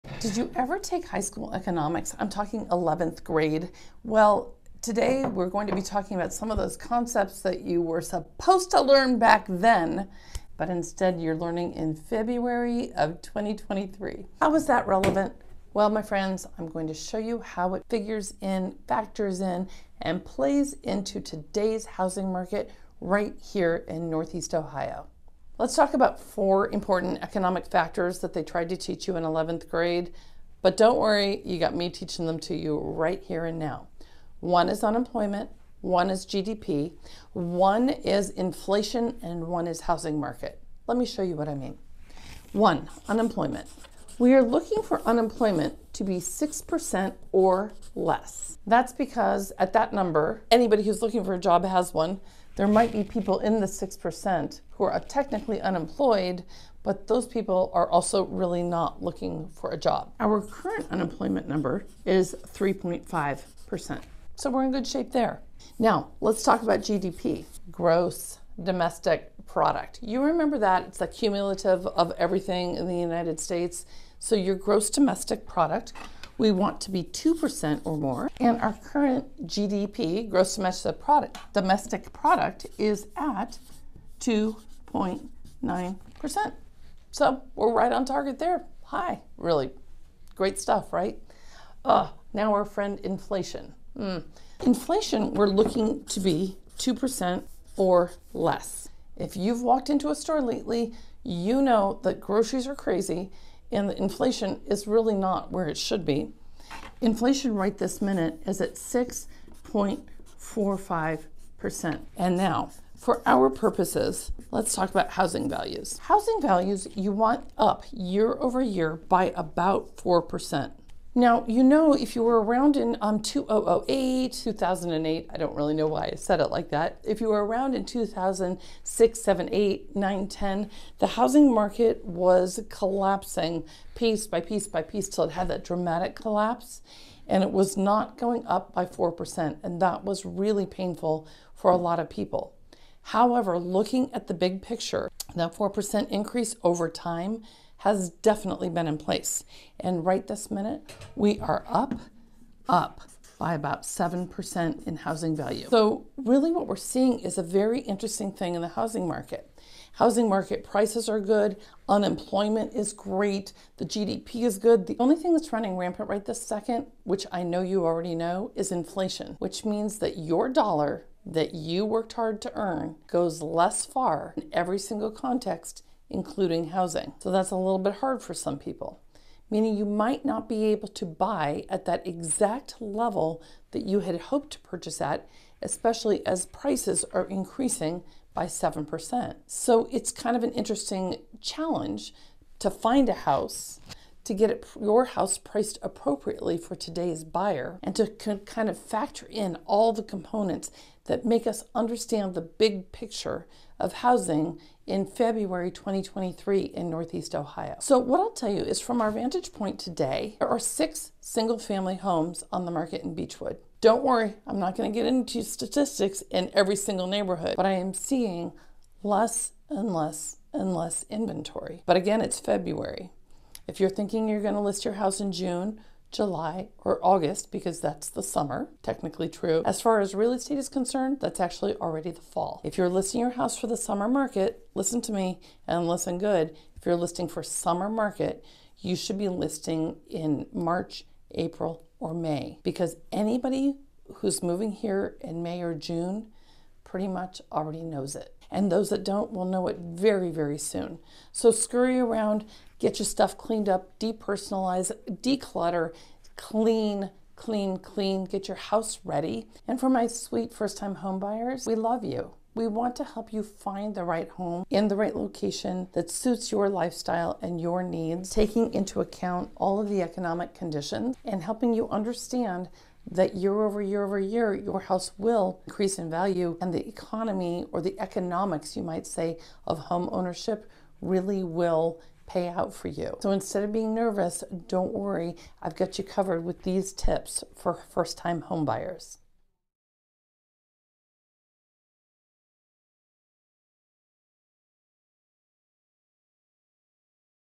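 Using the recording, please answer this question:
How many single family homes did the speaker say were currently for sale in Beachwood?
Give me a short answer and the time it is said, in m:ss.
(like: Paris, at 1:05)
6, at 3:30.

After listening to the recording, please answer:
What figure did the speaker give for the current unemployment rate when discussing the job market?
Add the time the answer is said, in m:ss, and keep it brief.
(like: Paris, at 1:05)
3.5%, at 1:02.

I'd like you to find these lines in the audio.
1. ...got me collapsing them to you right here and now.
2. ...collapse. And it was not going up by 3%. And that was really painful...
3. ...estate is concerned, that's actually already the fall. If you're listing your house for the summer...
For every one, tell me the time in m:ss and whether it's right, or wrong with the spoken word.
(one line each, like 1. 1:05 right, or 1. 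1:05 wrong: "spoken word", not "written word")
1. 0:31 wrong: "teaching", not "collapsing"
2. 2:16 wrong: "4", not "3"
3. 3:50 right.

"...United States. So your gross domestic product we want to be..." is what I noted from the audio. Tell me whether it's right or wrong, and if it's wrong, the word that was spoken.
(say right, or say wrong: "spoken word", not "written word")
right.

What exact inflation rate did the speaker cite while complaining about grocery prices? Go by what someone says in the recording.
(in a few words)
6.45%.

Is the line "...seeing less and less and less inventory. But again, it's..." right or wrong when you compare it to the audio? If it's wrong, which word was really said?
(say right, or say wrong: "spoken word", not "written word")
right.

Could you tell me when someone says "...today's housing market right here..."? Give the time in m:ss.
0:21.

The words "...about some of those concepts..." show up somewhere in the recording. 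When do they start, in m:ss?
0:06.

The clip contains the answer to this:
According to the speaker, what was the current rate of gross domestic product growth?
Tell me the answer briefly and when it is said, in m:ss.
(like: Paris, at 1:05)
2.9%, at 1:24.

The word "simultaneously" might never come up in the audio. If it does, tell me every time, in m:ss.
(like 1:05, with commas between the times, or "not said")
not said.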